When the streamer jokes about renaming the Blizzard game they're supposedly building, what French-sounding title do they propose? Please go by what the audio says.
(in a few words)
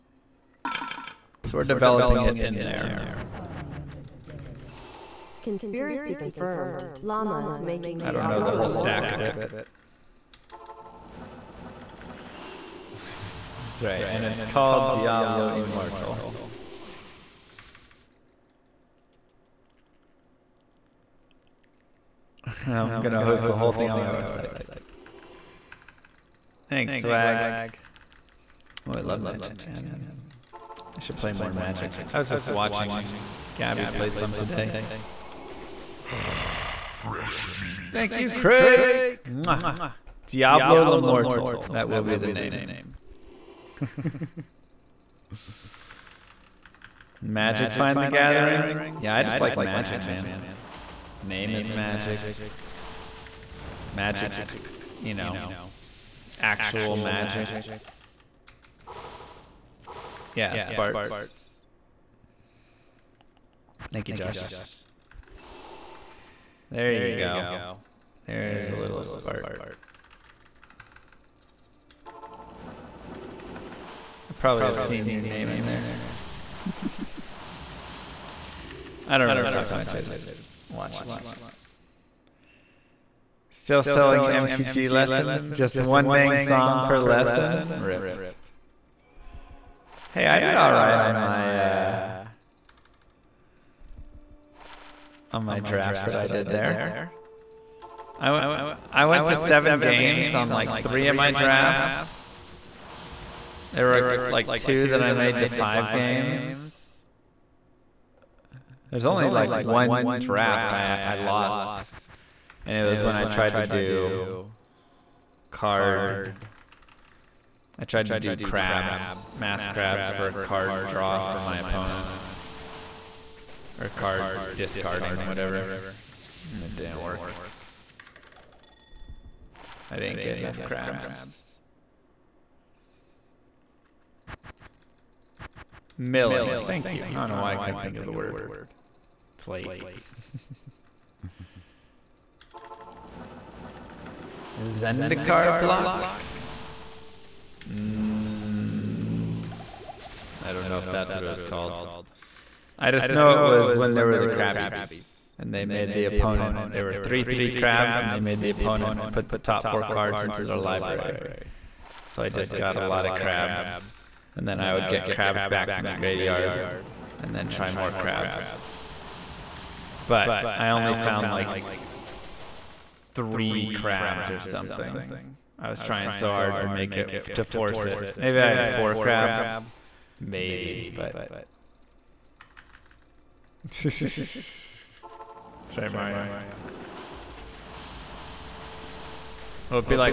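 Diablo L'Immortal.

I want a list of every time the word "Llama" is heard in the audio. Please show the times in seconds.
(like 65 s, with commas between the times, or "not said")
7 s.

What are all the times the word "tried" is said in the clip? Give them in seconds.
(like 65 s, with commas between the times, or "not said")
113 s, 117 s.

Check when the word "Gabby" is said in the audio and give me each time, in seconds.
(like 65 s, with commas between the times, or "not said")
33 s.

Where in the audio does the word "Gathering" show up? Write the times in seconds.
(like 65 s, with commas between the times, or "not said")
29 s, 48 s.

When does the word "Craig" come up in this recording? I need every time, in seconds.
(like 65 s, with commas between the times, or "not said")
38 s.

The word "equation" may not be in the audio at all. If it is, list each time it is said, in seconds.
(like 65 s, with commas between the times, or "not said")
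not said.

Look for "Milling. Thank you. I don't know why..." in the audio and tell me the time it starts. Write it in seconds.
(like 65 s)
135 s.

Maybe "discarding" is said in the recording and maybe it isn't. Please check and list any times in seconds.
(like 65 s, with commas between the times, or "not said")
124 s.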